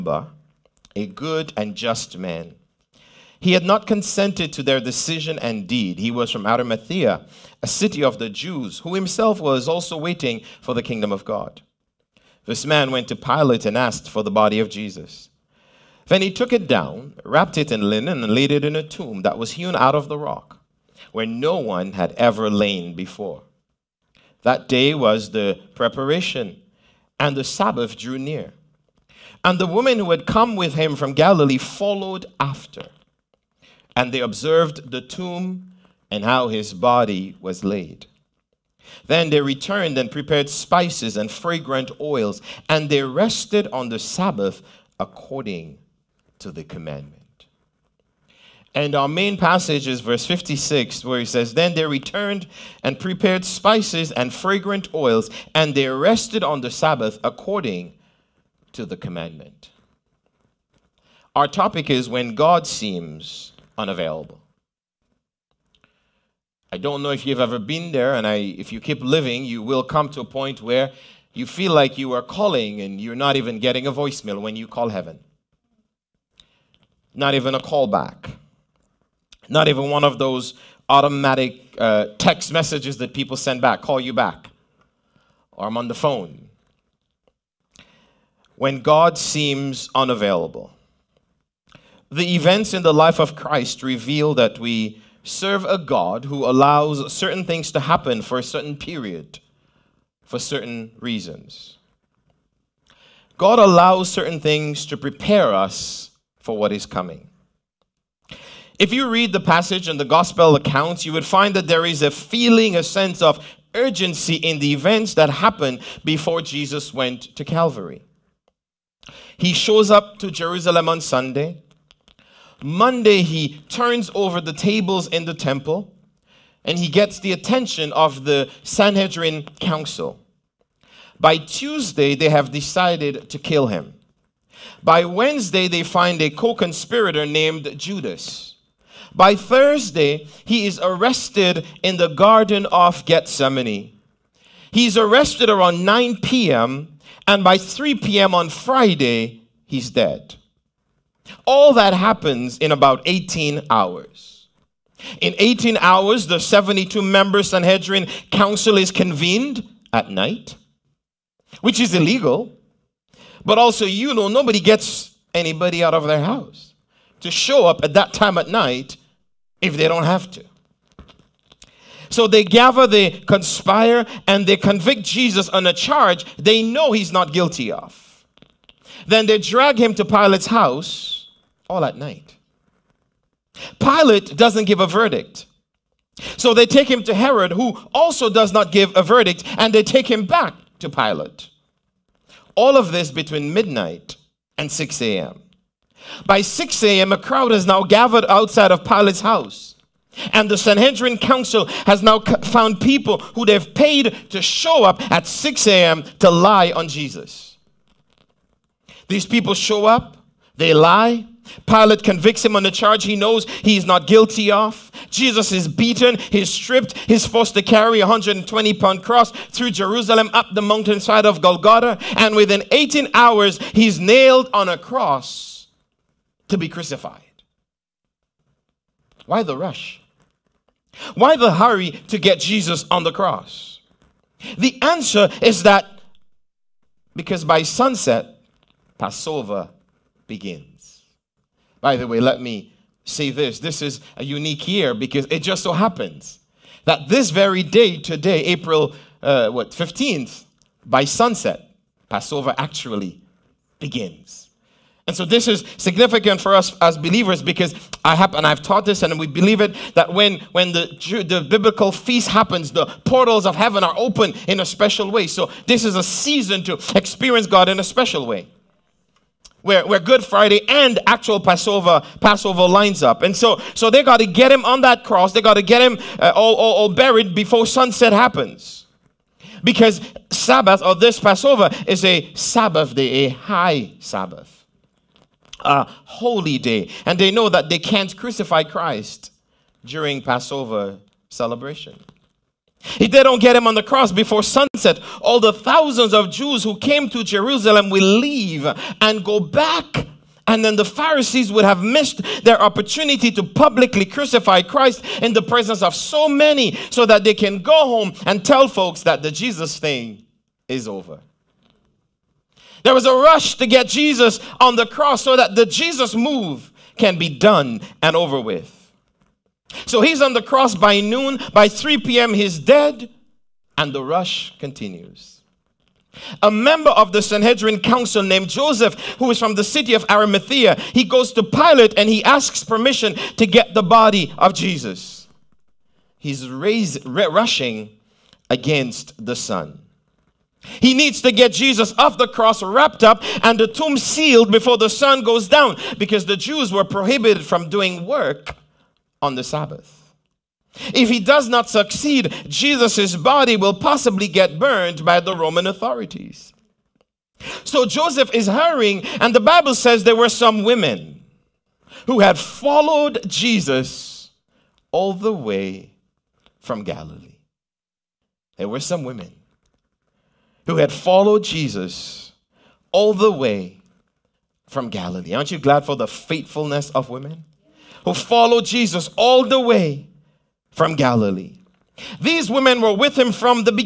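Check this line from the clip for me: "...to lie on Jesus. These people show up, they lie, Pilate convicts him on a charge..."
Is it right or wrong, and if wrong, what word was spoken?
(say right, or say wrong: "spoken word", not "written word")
right.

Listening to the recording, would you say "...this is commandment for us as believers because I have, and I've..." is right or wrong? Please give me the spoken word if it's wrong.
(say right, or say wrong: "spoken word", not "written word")
wrong: "significant", not "commandment".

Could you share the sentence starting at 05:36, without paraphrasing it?
He's raise, rushing against the sun.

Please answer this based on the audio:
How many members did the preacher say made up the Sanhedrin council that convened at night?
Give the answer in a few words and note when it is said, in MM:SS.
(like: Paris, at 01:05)
72, at 02:36.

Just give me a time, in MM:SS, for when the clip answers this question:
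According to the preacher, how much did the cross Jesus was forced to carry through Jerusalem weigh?
03:38.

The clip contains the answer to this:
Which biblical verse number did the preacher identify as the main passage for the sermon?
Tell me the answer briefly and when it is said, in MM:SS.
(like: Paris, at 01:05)
56, at 00:50.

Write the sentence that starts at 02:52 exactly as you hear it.
So they gather, they conspire, and they convict Jesus on a charge they know he's not guilty of.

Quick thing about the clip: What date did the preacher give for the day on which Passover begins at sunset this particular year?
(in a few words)
April 15.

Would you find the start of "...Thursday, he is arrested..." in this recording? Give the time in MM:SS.
02:19.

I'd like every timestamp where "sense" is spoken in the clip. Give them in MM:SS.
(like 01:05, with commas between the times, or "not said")
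01:52.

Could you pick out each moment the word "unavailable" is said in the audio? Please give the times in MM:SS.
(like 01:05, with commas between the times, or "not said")
01:03, 01:29.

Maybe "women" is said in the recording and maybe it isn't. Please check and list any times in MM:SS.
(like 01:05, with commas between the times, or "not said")
06:00, 06:09, 06:17, 06:22.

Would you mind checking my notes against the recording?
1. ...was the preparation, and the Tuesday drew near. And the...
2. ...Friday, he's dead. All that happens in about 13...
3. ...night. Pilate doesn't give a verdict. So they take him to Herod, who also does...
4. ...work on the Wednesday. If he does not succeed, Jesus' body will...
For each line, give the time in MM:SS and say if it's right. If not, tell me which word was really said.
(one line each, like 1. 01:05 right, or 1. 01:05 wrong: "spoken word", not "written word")
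1. 00:24 wrong: "Sabbath", not "Tuesday"
2. 02:28 wrong: "18", not "13"
3. 03:01 right
4. 05:48 wrong: "Sabbath", not "Wednesday".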